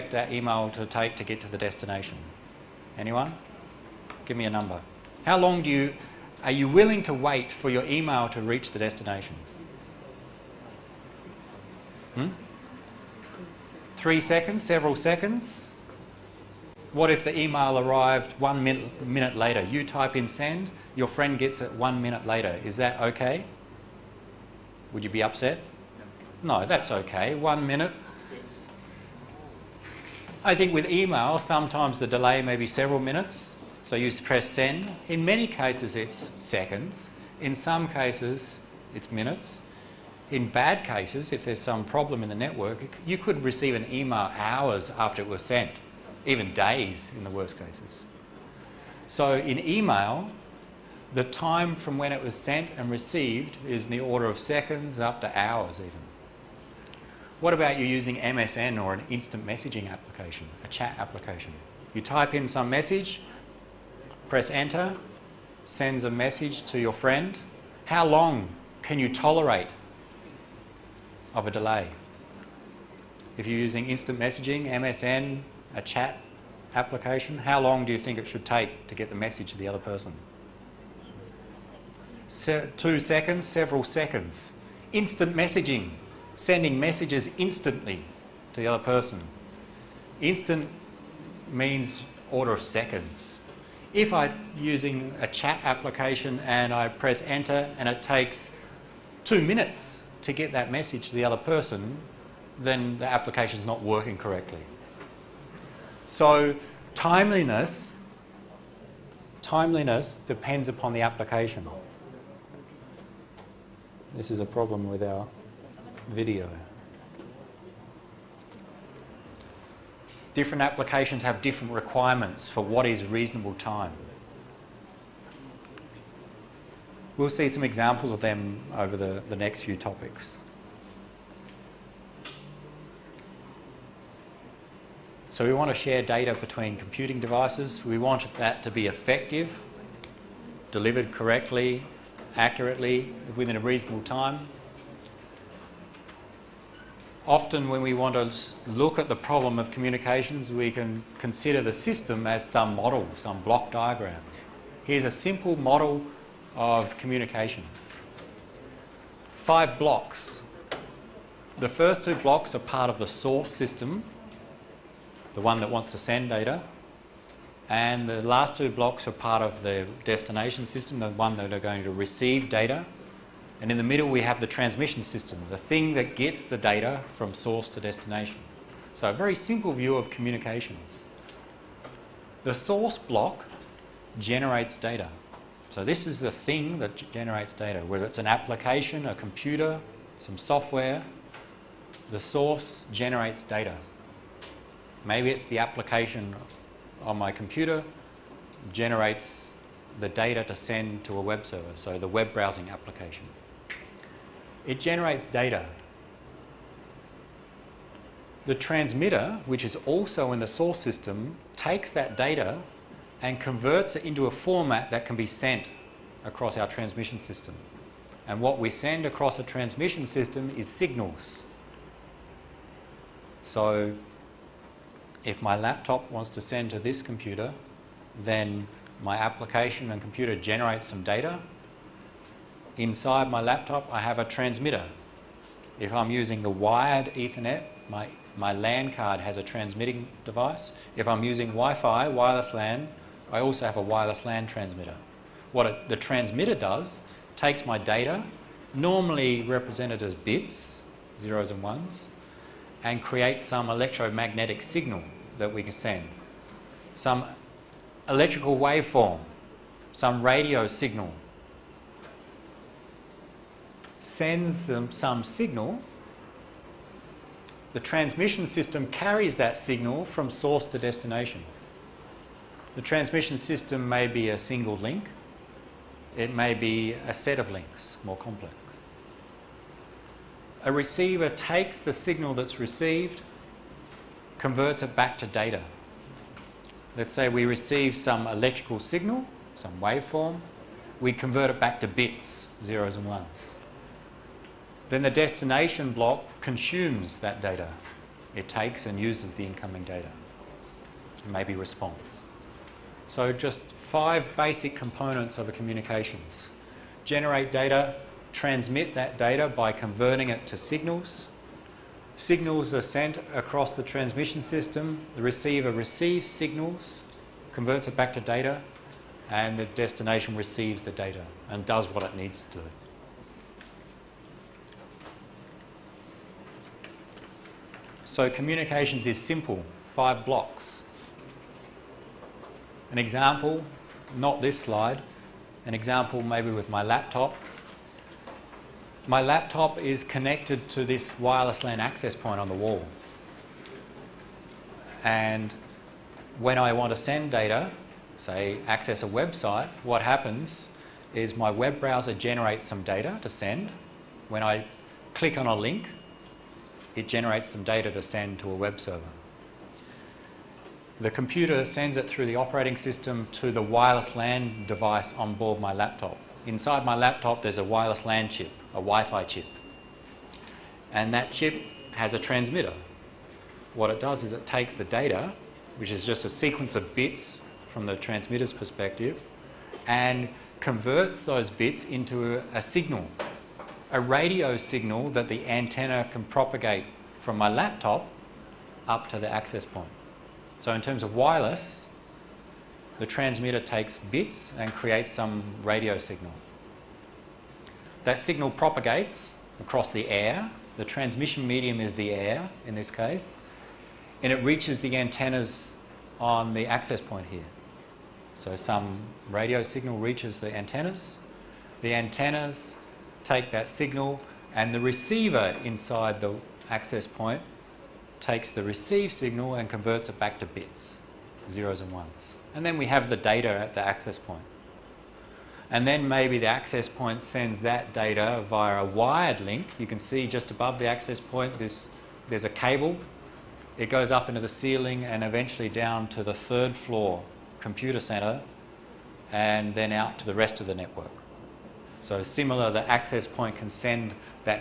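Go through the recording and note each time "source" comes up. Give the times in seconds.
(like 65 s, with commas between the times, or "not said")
163 s, 177 s, 182 s, 192 s, 210 s, 270 s.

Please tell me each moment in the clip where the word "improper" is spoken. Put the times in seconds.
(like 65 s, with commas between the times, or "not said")
not said.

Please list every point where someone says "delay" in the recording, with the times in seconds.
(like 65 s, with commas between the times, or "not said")
32 s, 71 s.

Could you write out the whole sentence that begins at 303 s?
So just five basic components of a communications.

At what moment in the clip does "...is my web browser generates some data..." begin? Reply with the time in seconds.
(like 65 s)
351 s.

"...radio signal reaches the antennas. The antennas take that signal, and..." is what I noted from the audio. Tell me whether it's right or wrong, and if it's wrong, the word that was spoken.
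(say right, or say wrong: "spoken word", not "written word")
right.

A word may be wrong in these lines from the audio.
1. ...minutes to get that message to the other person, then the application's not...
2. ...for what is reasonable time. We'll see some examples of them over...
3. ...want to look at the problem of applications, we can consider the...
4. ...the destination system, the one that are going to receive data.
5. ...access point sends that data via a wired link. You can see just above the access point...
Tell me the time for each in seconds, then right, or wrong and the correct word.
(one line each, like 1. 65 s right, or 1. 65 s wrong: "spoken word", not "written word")
1. 99 s right
2. 122 s right
3. 147 s wrong: "communications", not "applications"
4. 169 s right
5. 426 s right.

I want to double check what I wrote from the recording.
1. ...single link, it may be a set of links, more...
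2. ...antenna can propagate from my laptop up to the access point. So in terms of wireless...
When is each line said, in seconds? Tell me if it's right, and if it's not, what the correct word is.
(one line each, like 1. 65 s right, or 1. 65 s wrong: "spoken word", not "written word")
1. 274 s right
2. 385 s right.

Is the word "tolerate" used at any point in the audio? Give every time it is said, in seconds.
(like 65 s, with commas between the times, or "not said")
69 s.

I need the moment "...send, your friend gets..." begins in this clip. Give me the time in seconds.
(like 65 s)
20 s.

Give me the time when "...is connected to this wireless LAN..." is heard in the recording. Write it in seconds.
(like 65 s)
339 s.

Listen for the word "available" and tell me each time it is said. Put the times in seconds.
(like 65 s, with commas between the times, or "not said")
not said.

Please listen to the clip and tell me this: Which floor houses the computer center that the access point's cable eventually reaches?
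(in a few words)
third floor.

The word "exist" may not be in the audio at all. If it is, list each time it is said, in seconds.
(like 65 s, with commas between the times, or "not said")
not said.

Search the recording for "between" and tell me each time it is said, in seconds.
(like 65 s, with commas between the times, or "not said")
136 s.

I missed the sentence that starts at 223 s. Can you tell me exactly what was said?
So if my laptop wants to send to this computer, then my application and computer generates some data.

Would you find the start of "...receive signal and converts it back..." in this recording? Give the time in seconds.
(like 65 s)
418 s.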